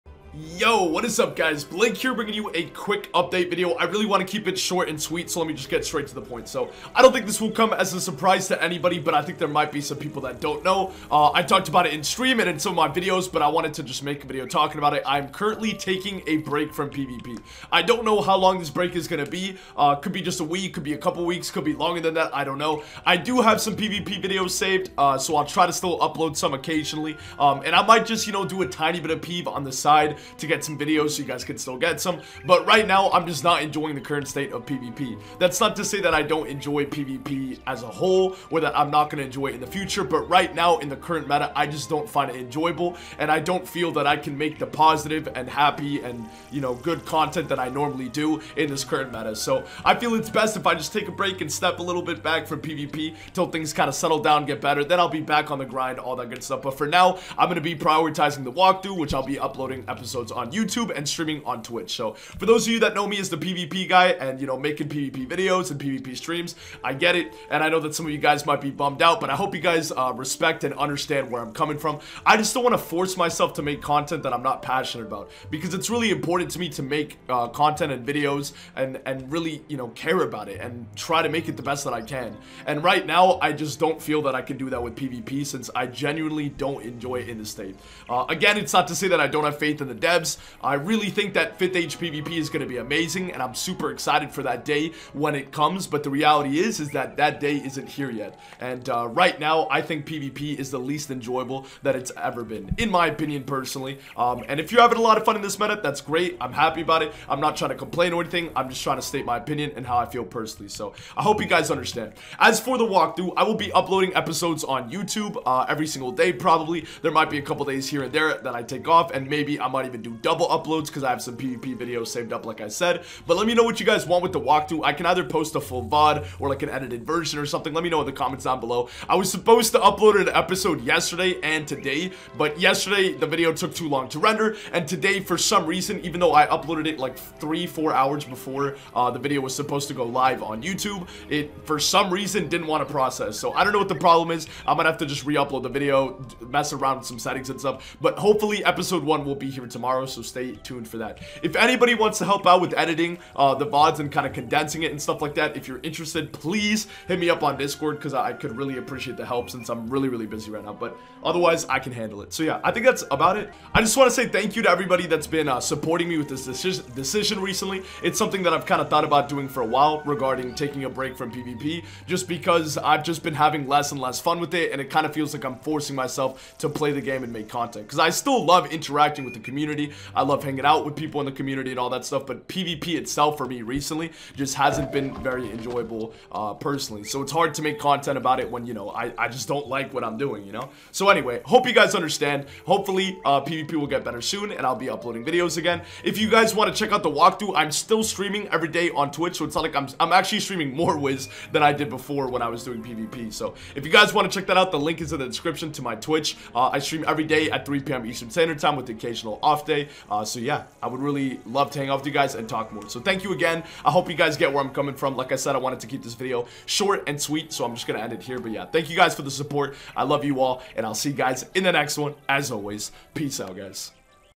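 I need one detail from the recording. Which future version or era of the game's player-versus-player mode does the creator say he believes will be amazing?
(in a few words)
5th Age.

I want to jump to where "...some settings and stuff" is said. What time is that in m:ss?
2:27.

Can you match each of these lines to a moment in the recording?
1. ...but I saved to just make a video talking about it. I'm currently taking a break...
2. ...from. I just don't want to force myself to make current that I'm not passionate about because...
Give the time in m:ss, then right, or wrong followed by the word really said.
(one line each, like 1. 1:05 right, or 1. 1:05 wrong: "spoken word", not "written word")
1. 0:13 wrong: "wanted", not "saved"
2. 1:11 wrong: "content", not "current".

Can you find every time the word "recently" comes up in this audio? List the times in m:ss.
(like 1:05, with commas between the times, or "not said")
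2:47, 3:03.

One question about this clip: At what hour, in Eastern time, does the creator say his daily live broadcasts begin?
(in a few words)
3 p.m.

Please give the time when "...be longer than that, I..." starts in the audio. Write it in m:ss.
0:21.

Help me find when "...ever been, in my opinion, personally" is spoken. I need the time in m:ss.
1:42.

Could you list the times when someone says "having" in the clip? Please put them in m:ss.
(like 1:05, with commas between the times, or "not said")
1:44, 2:53.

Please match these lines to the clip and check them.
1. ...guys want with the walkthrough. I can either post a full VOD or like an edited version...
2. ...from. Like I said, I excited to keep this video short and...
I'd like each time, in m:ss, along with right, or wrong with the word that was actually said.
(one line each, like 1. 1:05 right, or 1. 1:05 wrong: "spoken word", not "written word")
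1. 2:03 right
2. 3:34 wrong: "wanted", not "excited".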